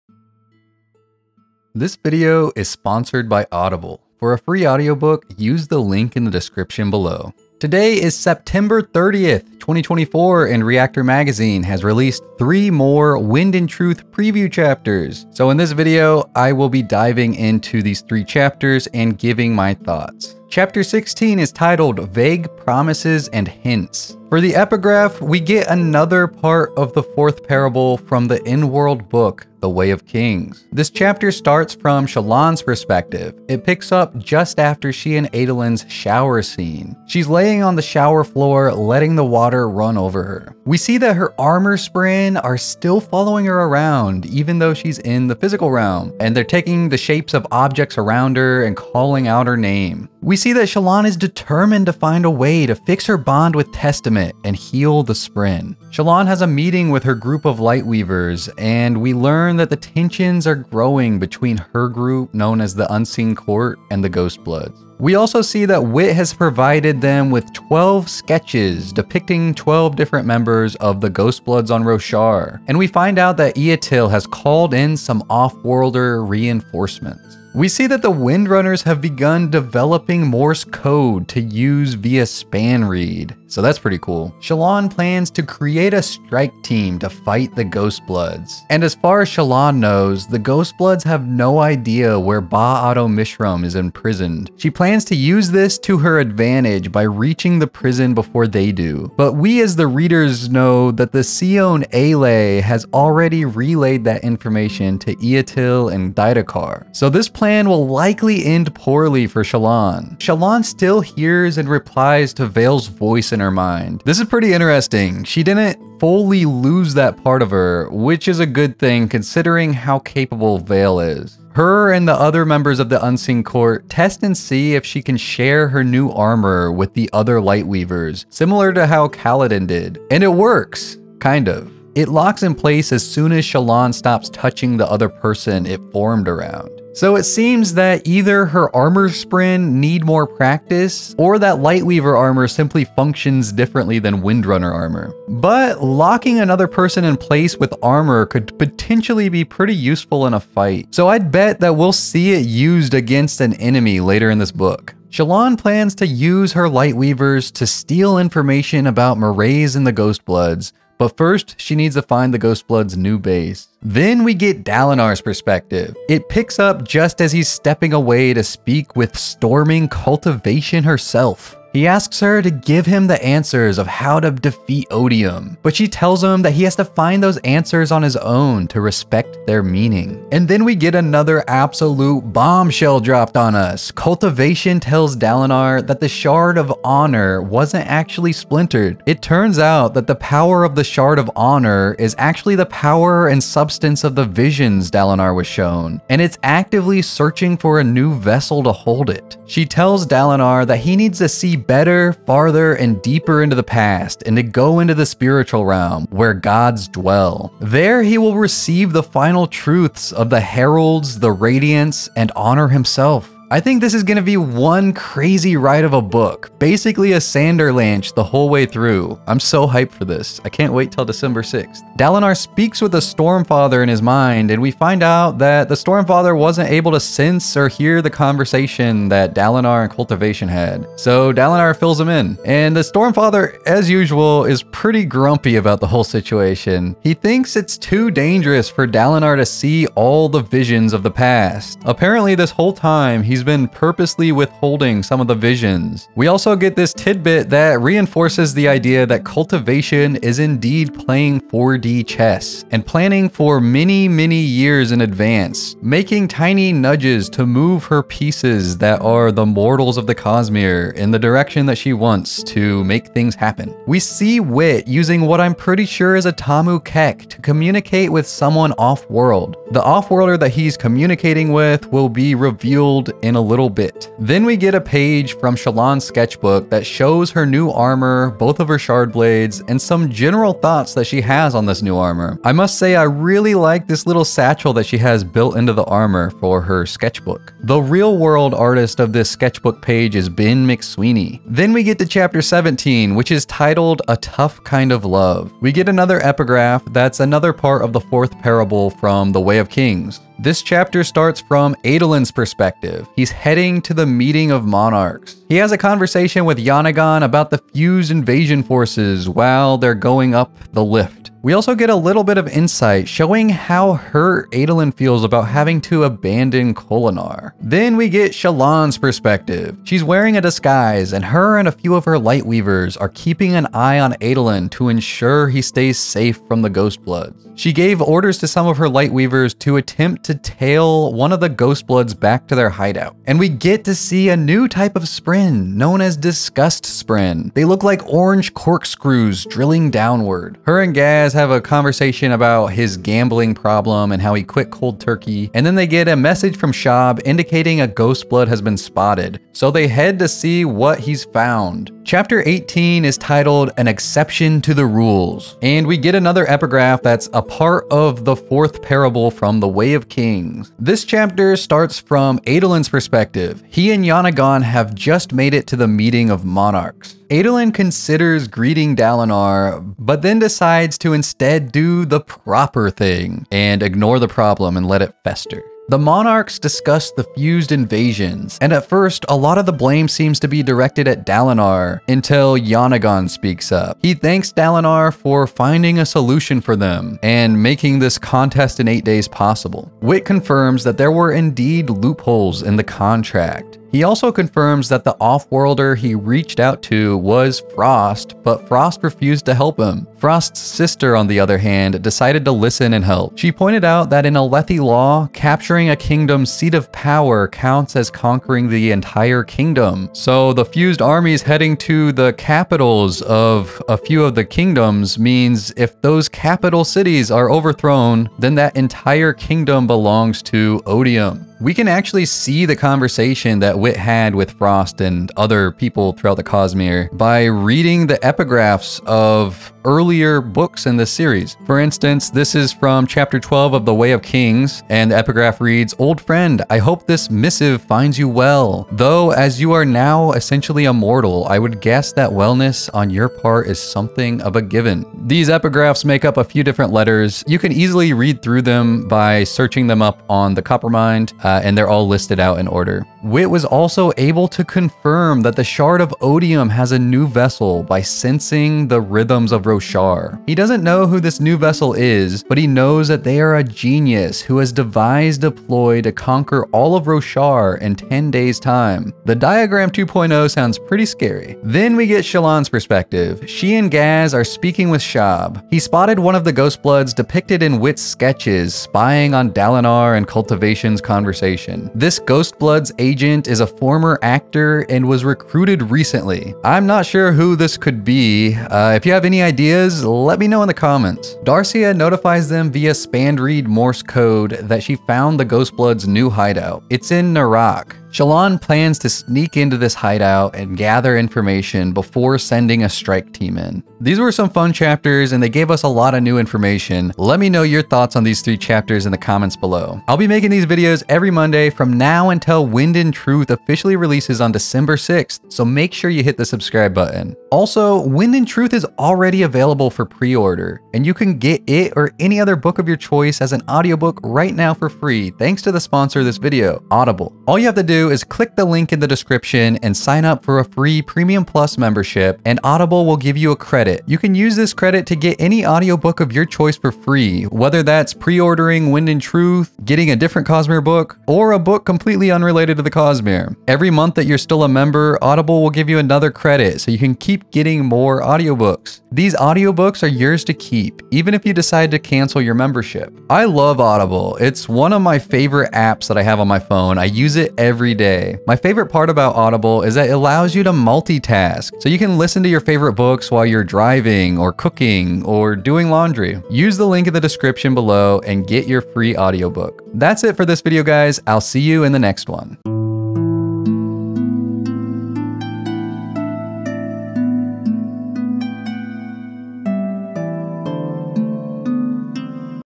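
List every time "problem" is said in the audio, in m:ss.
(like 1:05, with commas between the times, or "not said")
5:43, 6:14.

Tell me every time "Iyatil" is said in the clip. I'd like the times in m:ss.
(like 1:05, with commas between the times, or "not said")
1:13, 1:45.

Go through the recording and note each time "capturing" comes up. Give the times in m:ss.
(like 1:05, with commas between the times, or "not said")
6:45.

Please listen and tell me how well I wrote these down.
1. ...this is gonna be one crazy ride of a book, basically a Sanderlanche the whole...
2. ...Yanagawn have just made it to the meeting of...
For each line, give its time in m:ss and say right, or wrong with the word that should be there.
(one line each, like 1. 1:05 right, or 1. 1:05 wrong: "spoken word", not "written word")
1. 3:33 right
2. 6:04 right.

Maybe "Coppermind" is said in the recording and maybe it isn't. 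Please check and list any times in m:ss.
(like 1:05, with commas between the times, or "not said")
7:30.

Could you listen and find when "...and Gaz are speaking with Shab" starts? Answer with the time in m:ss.
7:53.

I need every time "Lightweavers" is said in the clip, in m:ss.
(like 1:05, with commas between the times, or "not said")
0:57, 2:07, 2:21, 2:36, 5:22, 5:28.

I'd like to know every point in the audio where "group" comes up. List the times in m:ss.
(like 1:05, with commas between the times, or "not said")
0:57, 1:01.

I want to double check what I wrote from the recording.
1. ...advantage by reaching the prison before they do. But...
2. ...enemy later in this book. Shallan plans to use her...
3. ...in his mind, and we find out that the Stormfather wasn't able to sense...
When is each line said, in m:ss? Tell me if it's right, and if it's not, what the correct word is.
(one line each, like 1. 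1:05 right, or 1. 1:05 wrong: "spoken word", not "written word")
1. 1:36 right
2. 2:33 right
3. 3:43 right.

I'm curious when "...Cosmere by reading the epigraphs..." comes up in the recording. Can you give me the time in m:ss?
7:06.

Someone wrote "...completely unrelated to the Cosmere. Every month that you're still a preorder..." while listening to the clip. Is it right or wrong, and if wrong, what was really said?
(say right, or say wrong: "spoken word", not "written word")
wrong: "member", not "preorder".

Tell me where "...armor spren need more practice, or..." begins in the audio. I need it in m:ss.
2:18.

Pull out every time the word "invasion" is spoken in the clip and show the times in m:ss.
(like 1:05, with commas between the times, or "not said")
5:08, 6:17.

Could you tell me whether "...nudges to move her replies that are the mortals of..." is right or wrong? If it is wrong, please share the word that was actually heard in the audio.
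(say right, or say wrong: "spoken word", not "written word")
wrong: "pieces", not "replies".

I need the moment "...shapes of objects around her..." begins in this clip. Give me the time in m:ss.
0:46.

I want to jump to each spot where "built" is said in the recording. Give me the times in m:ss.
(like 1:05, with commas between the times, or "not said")
4:45.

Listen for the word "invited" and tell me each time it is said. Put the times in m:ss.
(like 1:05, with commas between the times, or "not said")
not said.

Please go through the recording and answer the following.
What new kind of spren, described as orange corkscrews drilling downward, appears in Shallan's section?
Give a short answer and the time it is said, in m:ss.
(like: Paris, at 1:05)
Disgust spren, at 5:36.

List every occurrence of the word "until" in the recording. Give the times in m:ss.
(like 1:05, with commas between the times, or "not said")
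6:22, 8:32.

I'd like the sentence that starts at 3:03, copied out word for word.
Cultivation tells Dalinar that the Shard of Honor wasn't actually splintered.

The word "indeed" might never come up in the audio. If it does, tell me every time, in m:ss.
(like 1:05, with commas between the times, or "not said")
4:10, 6:31.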